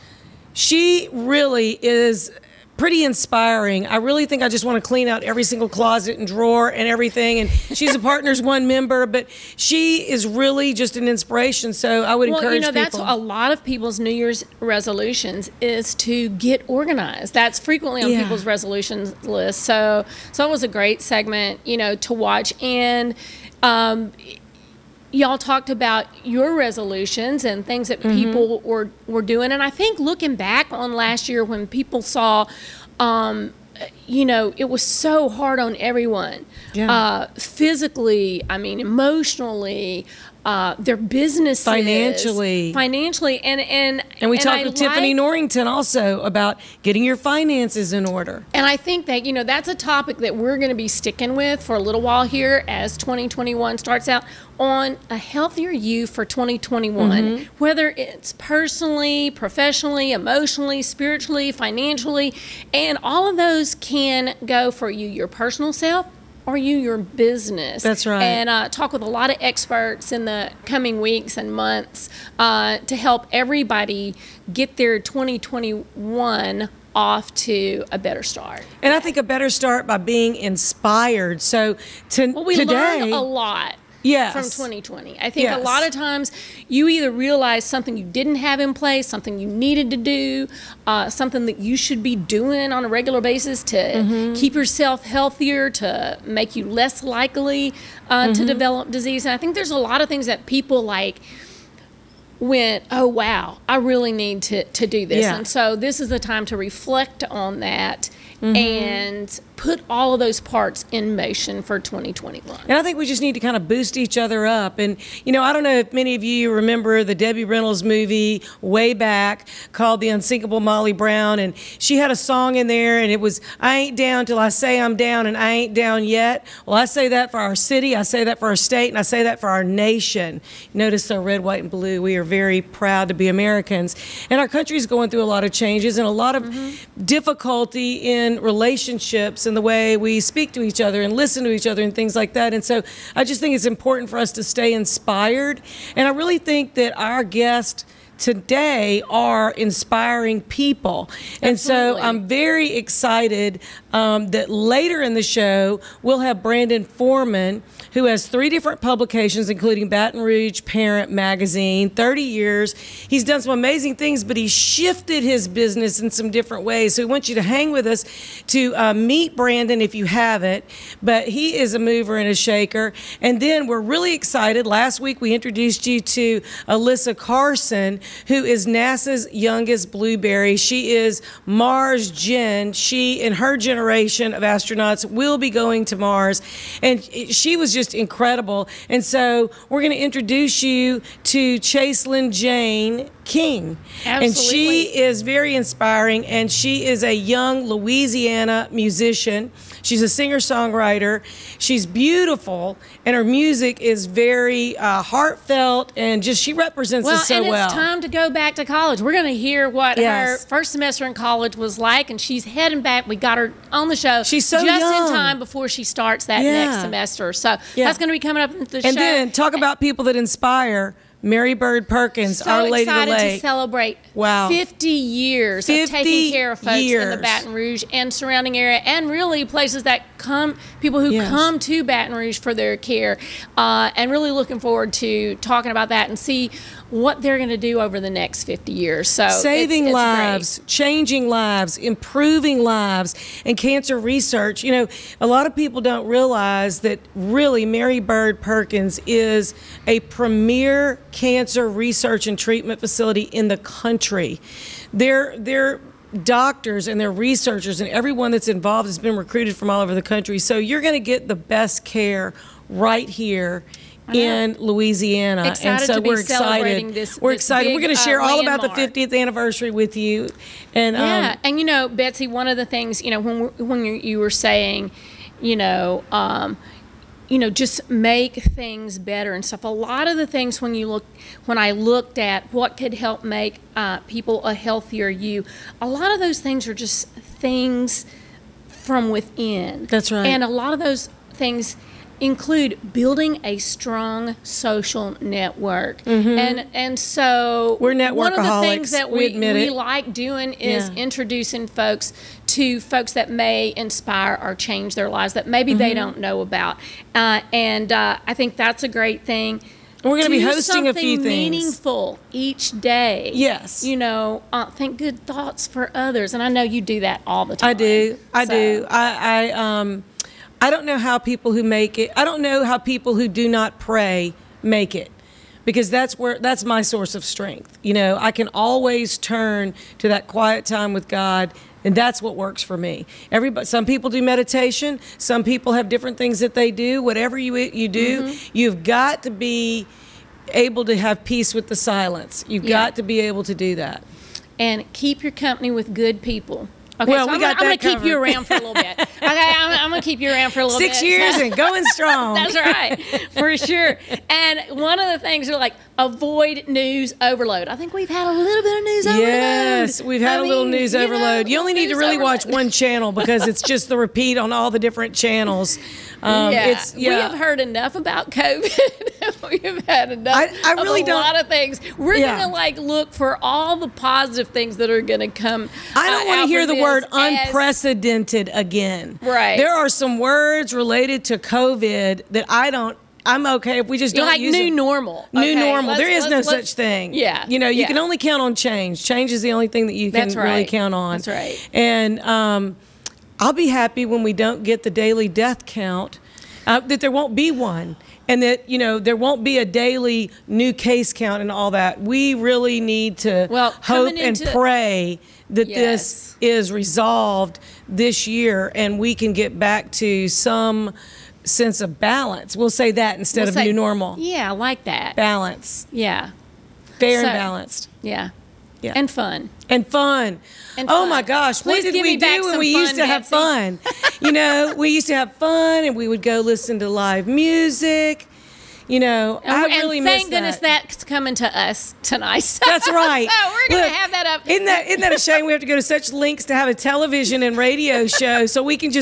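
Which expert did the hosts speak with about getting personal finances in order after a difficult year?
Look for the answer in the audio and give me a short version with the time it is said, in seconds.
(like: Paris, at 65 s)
Tiffany Norrington, at 44 s.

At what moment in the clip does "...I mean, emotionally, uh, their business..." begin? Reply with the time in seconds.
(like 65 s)
38 s.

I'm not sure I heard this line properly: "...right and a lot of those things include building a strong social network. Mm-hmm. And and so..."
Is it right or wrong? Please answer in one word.
right.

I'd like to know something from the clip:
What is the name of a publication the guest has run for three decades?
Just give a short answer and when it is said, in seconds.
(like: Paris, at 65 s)
Baton Rouge Parent Magazine, at 159 s.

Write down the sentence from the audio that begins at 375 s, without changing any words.
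I don't uh, want to hear the word unprecedented as, again.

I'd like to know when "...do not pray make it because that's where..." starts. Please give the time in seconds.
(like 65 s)
323 s.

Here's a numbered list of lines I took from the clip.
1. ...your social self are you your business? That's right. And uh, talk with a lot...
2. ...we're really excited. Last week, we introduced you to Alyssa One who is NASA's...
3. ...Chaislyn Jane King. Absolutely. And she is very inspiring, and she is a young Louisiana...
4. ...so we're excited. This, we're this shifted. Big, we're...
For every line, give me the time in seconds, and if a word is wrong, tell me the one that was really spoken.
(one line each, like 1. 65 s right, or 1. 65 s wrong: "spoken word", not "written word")
1. 65 s wrong: "personal", not "social"
2. 173 s wrong: "Carson", not "One"
3. 191 s right
4. 265 s wrong: "excited", not "shifted".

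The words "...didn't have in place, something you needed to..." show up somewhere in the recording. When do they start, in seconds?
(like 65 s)
88 s.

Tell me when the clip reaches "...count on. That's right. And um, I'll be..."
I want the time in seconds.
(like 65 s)
390 s.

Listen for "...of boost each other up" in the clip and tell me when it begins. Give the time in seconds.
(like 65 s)
113 s.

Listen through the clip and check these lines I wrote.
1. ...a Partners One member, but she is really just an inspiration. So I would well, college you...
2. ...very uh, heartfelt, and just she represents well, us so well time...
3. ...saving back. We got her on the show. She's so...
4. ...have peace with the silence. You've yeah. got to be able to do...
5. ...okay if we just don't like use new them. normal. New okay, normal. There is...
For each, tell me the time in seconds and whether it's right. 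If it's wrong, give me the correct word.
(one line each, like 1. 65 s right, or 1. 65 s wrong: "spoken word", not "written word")
1. 7 s wrong: "encourage", not "college"
2. 204 s right
3. 212 s wrong: "heading", not "saving"
4. 340 s right
5. 383 s right.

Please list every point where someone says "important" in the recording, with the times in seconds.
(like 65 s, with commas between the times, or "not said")
143 s.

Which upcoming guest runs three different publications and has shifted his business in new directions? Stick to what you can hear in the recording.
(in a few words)
Brandon Foreman.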